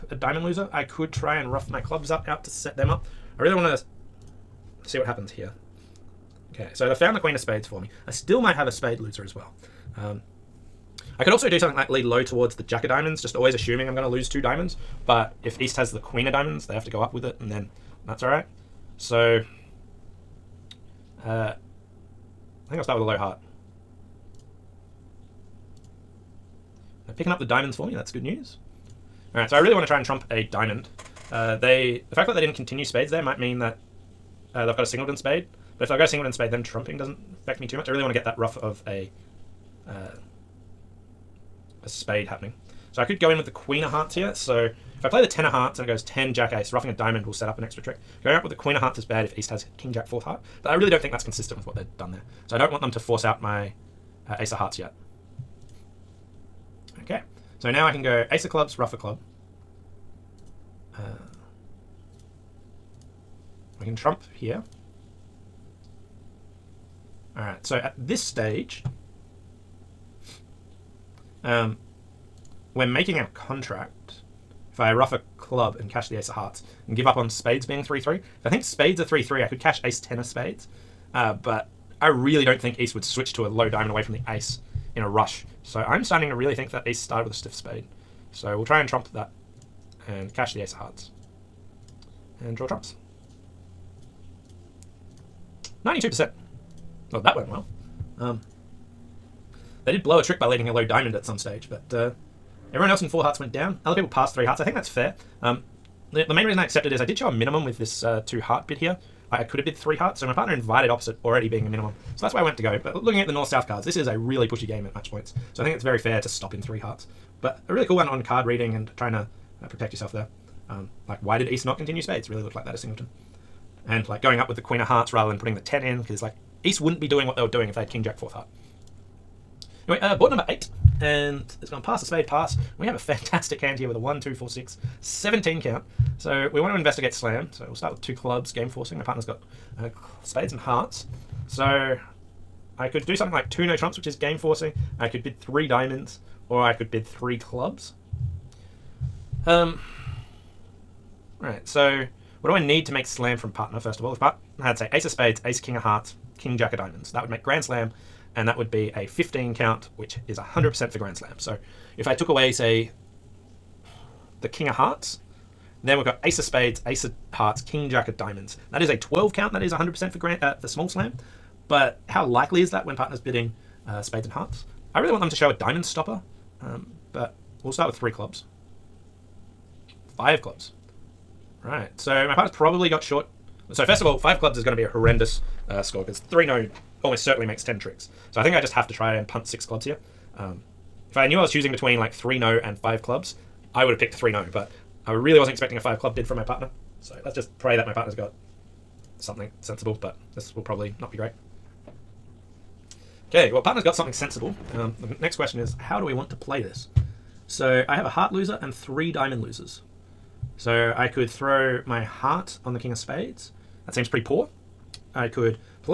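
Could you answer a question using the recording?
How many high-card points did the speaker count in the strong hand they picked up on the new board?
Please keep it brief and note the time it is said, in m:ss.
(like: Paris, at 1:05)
17, at 2:15.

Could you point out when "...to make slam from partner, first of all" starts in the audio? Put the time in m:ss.
2:32.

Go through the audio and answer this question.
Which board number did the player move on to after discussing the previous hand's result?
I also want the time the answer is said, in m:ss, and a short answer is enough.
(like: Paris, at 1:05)
8, at 2:10.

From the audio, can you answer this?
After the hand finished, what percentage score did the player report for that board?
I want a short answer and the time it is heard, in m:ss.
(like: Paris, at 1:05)
92%, at 1:35.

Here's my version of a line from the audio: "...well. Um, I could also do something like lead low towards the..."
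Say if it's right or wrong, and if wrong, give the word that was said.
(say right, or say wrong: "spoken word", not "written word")
right.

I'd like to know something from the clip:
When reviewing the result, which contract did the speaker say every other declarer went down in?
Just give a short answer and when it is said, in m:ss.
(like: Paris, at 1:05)
four hearts, at 1:43.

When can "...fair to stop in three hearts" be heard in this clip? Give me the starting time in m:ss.
1:55.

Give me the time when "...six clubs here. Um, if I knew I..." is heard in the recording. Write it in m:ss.
3:09.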